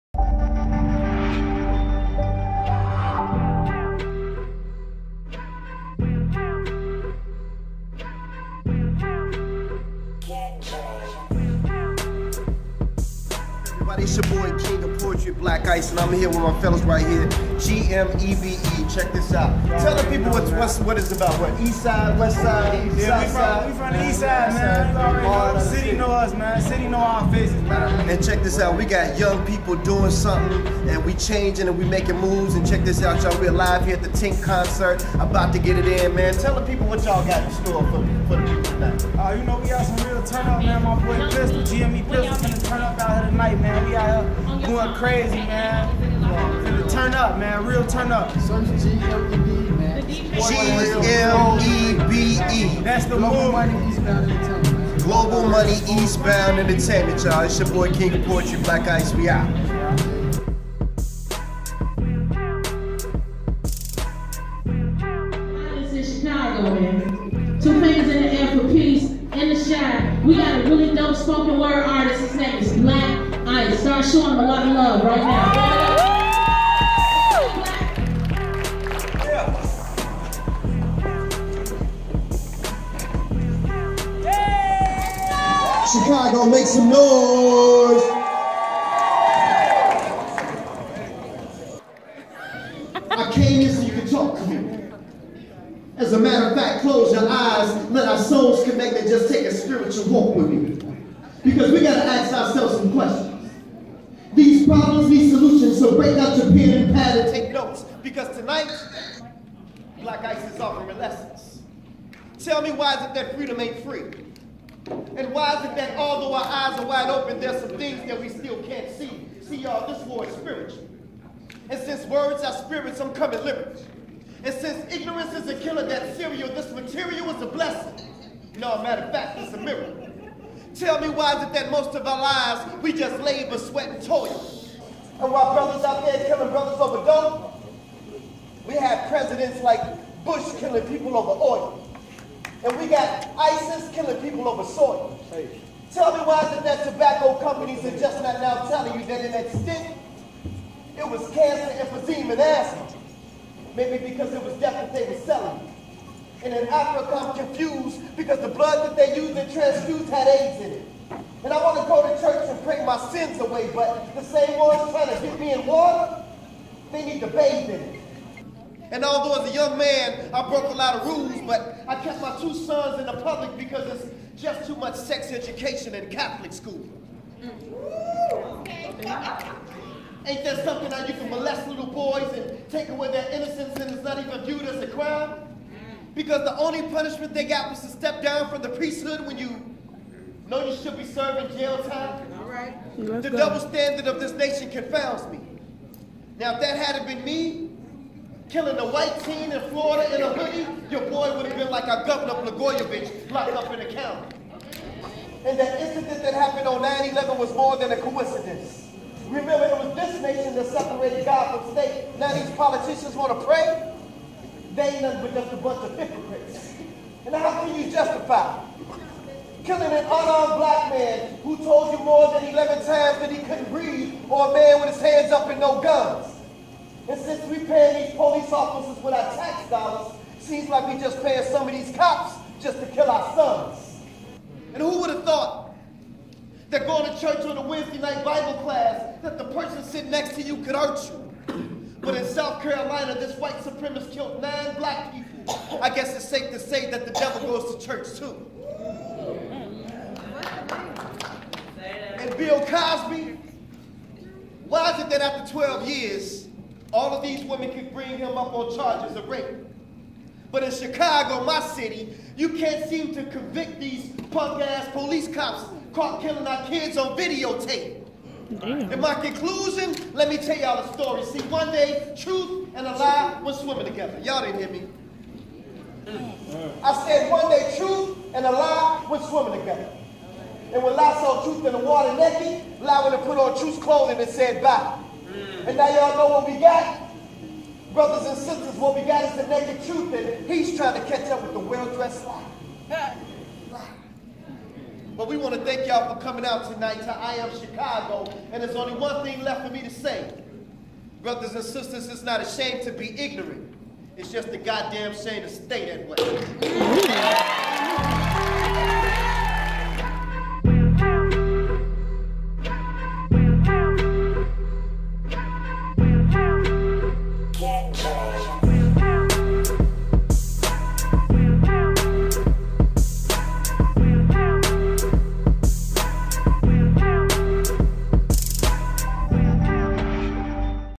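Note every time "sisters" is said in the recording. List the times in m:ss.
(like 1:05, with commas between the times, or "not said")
4:48, 5:01.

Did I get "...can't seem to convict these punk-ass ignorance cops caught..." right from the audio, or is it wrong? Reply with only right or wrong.
wrong.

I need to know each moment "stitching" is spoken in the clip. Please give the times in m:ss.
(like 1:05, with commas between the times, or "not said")
not said.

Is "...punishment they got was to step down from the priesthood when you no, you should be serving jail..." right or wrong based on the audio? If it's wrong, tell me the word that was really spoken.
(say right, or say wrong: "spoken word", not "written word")
right.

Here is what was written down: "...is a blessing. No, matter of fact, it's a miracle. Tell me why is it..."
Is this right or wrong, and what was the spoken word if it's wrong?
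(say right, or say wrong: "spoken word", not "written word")
right.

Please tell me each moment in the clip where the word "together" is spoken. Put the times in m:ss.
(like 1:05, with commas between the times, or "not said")
4:33, 4:39.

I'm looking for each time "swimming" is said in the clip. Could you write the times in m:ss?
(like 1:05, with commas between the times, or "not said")
4:33, 4:39.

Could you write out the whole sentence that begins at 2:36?
And in Africa, I'm confused because the blood that they used in transfused had AIDS in it.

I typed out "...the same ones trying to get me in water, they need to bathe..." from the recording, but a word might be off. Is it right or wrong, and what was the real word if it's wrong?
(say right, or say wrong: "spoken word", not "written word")
right.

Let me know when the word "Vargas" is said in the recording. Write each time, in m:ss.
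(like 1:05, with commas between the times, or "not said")
not said.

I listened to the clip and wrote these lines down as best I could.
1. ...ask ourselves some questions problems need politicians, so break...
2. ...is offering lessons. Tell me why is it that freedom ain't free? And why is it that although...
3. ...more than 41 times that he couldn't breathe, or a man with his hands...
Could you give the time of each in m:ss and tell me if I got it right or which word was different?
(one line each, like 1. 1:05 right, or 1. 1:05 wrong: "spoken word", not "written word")
1. 1:42 wrong: "solutions", not "politicians"
2. 1:50 right
3. 3:42 wrong: "11", not "41".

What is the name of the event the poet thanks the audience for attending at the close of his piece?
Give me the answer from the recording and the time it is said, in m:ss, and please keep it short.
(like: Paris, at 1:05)
I Am Chicago, at 4:57.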